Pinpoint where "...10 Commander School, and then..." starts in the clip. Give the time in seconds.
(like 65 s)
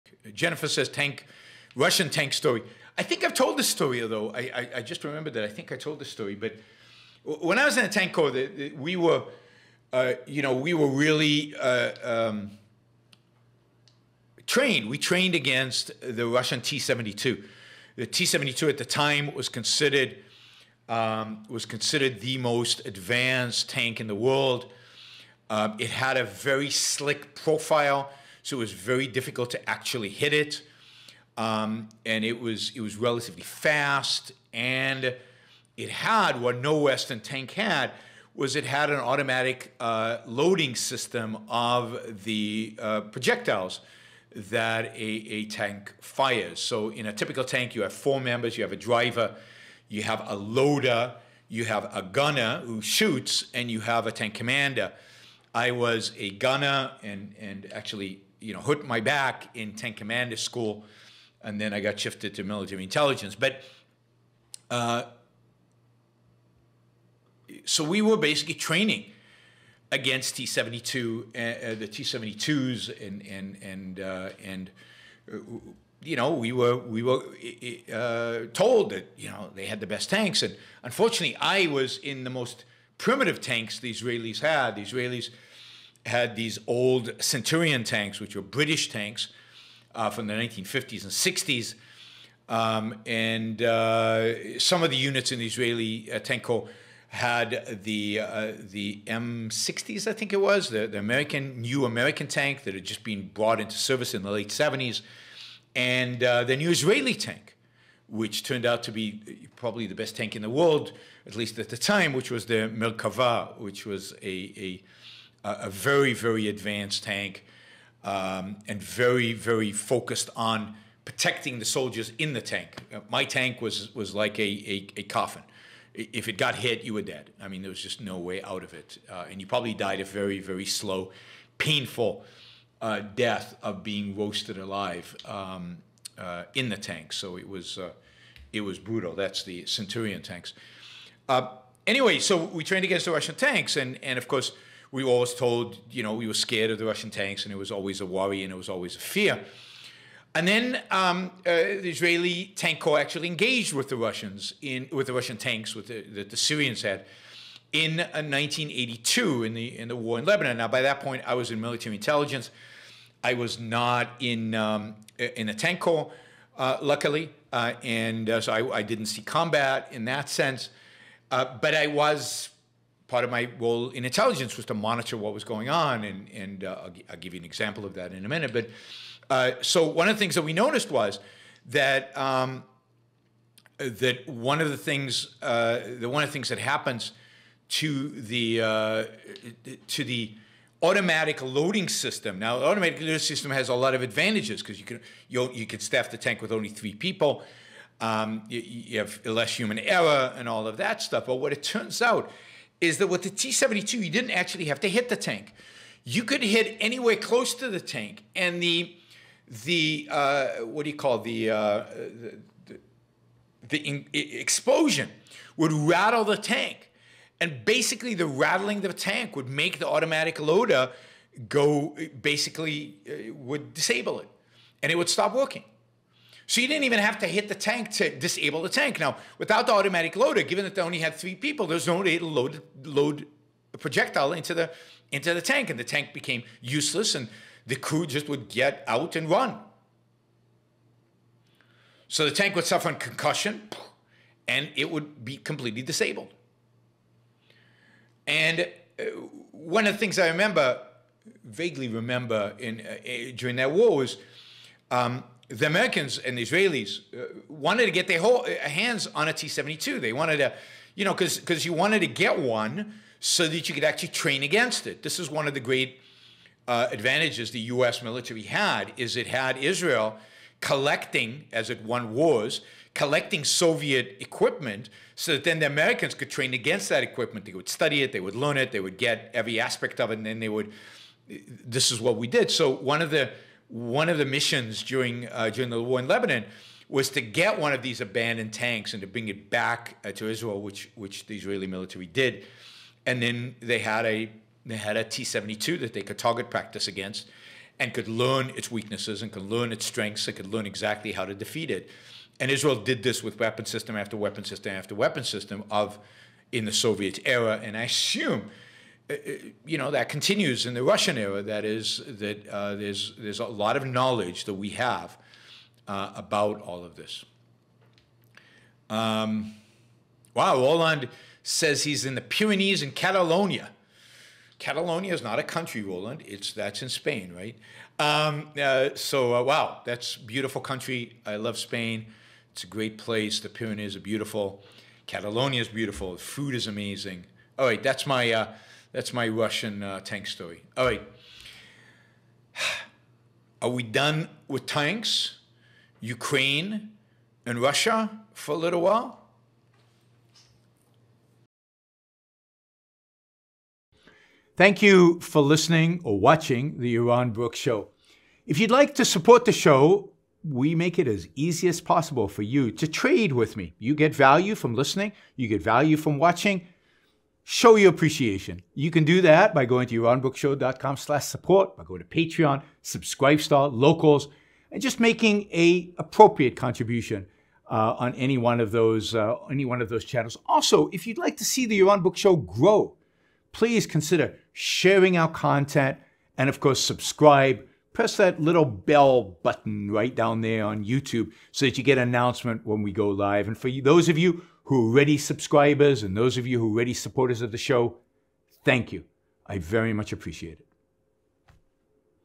59 s.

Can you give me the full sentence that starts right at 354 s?
Thank you for listening or watching the Yaron Brook Show.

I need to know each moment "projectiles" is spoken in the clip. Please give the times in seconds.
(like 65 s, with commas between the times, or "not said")
43 s, 233 s.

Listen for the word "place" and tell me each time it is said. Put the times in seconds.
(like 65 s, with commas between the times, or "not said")
332 s.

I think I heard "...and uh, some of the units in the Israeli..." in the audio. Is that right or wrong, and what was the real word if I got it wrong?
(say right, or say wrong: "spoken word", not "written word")
right.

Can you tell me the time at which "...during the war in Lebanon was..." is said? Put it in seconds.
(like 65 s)
285 s.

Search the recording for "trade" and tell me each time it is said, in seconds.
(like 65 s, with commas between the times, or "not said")
362 s.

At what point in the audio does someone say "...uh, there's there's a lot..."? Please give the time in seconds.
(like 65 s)
312 s.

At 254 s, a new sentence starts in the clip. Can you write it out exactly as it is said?
Um, the Americans and the Israelis uh, wanted to get their whole, uh, hands on a T-72.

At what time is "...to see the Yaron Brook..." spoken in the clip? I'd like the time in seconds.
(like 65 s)
381 s.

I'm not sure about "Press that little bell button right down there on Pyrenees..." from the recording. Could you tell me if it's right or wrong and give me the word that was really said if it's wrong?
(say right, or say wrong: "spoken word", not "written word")
wrong: "YouTube", not "Pyrenees".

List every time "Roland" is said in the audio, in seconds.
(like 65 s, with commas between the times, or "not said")
320 s, 325 s.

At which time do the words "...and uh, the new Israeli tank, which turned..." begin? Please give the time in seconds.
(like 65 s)
105 s.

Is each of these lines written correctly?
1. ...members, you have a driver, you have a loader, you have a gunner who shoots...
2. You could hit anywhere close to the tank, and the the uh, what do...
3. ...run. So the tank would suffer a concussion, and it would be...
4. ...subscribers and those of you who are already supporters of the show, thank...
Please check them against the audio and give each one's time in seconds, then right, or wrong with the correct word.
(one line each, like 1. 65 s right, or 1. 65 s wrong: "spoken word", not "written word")
1. 48 s right
2. 206 s right
3. 239 s right
4. 395 s right.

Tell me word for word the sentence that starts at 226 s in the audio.
So you didn't even have to hit the tank to disable the tank.